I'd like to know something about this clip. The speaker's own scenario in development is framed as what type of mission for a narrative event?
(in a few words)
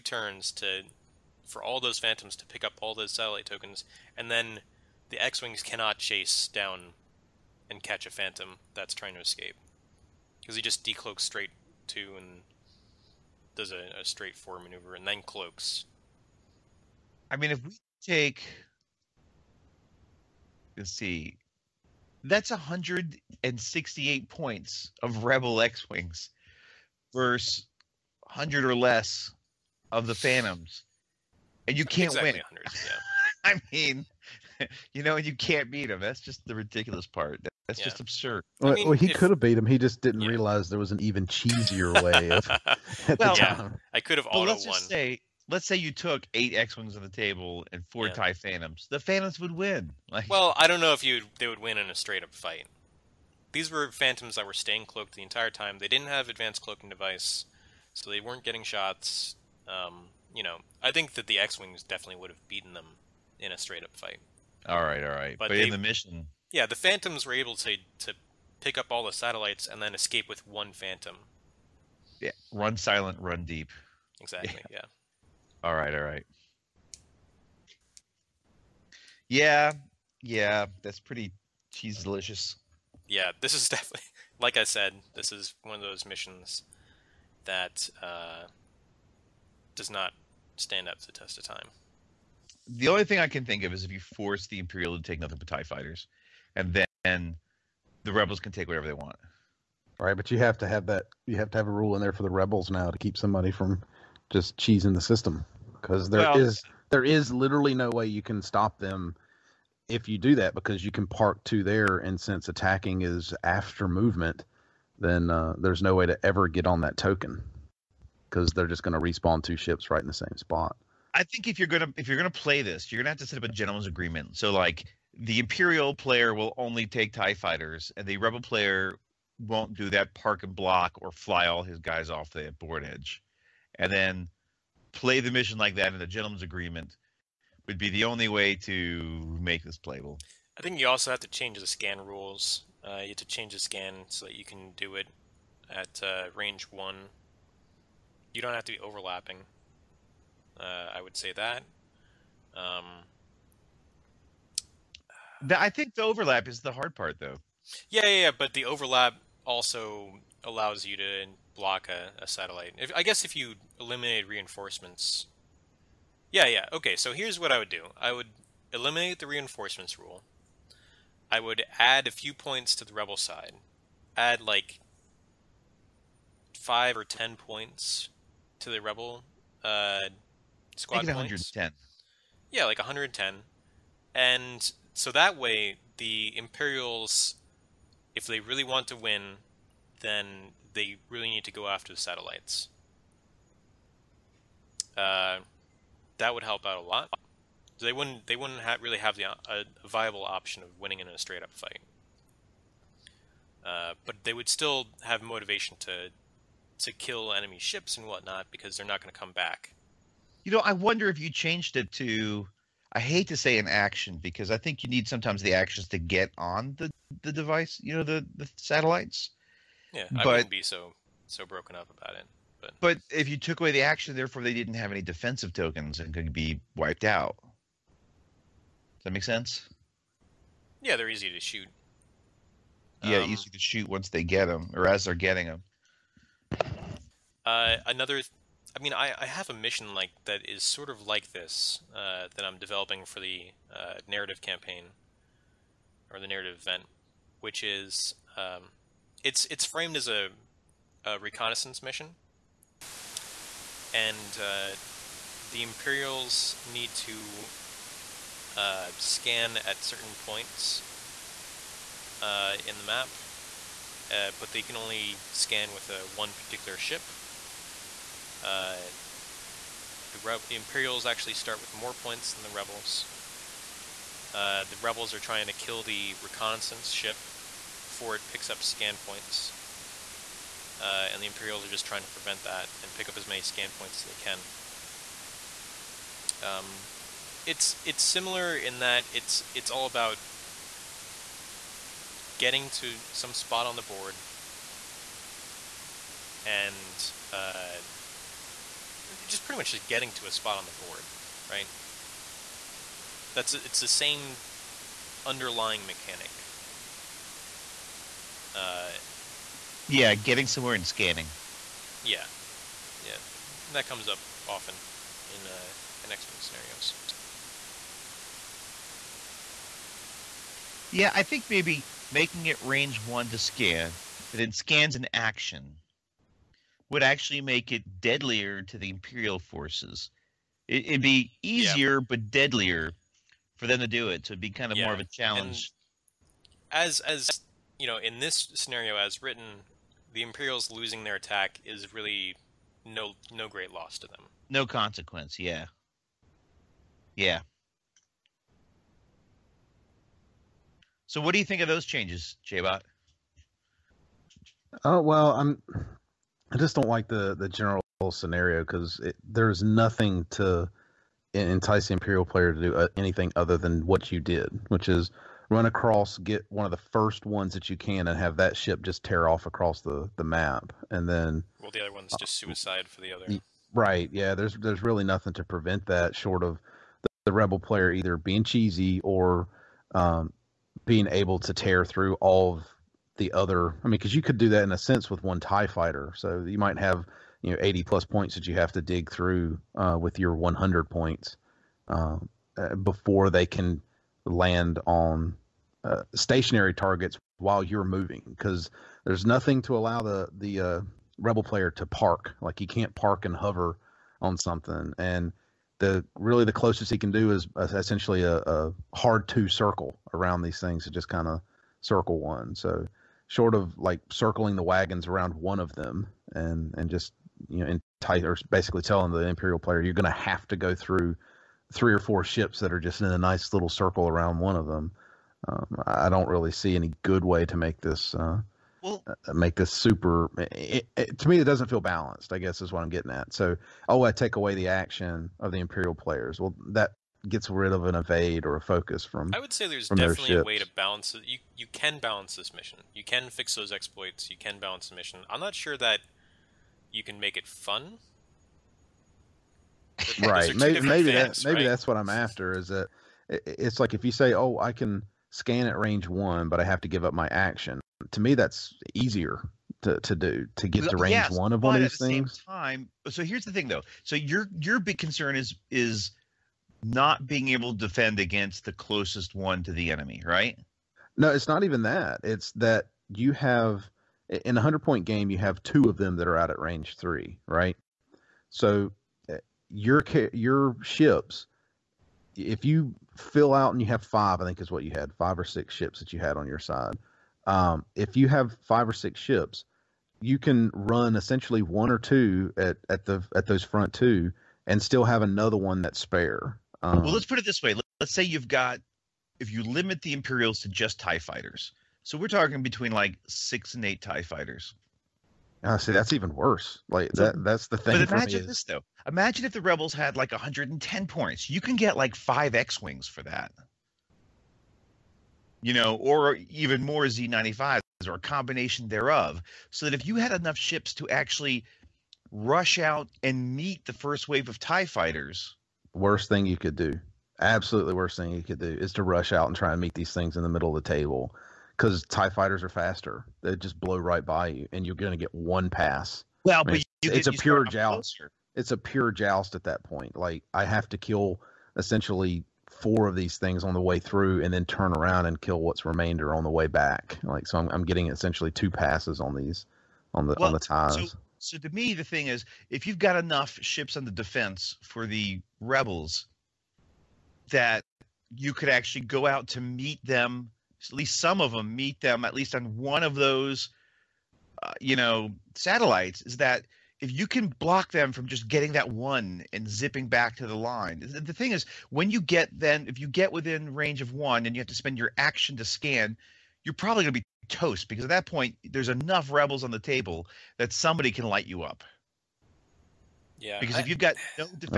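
Reconnaissance mission.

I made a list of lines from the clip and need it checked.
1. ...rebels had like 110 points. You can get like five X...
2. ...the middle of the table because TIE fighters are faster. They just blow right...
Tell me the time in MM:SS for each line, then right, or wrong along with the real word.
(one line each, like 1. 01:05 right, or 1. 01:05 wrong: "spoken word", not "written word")
1. 08:29 right
2. 08:50 right.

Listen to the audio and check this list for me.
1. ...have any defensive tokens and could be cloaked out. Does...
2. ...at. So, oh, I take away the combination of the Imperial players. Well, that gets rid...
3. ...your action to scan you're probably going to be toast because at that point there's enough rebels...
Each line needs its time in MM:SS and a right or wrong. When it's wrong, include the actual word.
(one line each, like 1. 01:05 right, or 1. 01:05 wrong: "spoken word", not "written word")
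1. 03:44 wrong: "wiped", not "cloaked"
2. 07:13 wrong: "action", not "combination"
3. 09:34 right.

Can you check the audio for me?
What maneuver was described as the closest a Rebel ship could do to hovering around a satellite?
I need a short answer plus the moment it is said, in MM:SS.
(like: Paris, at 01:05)
Hard 2, at 06:48.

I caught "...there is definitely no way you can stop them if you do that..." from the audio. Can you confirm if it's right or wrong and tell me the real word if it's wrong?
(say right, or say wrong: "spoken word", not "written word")
wrong: "literally", not "definitely".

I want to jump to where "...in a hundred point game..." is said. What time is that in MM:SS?
07:54.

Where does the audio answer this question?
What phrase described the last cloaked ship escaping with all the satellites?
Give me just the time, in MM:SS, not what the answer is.
01:12.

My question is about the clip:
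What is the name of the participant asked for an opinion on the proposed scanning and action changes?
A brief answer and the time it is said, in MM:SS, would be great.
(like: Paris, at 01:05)
J-Bot, at 05:52.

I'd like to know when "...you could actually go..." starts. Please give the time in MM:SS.
09:18.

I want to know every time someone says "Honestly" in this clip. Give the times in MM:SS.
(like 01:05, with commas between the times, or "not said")
08:25.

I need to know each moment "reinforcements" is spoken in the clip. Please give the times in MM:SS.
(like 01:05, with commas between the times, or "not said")
02:44, 02:49.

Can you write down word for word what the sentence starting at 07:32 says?
Is that it's like if you say, oh, I can scan at range one, but I have to give up my action.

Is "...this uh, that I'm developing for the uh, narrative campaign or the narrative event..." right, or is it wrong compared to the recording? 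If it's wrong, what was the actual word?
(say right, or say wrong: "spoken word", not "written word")
right.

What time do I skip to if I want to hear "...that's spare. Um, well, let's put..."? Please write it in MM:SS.
08:15.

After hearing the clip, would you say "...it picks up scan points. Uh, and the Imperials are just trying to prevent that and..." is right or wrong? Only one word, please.
right.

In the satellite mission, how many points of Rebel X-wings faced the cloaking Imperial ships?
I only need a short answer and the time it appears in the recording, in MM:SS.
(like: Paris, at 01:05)
168, at 00:22.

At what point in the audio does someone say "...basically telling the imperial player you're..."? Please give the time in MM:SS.
06:58.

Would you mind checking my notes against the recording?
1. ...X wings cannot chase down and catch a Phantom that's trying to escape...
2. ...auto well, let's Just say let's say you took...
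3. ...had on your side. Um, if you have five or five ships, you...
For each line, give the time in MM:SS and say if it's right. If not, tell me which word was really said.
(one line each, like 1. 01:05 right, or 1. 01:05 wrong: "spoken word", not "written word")
1. 00:05 right
2. 00:44 right
3. 08:06 wrong: "six", not "five".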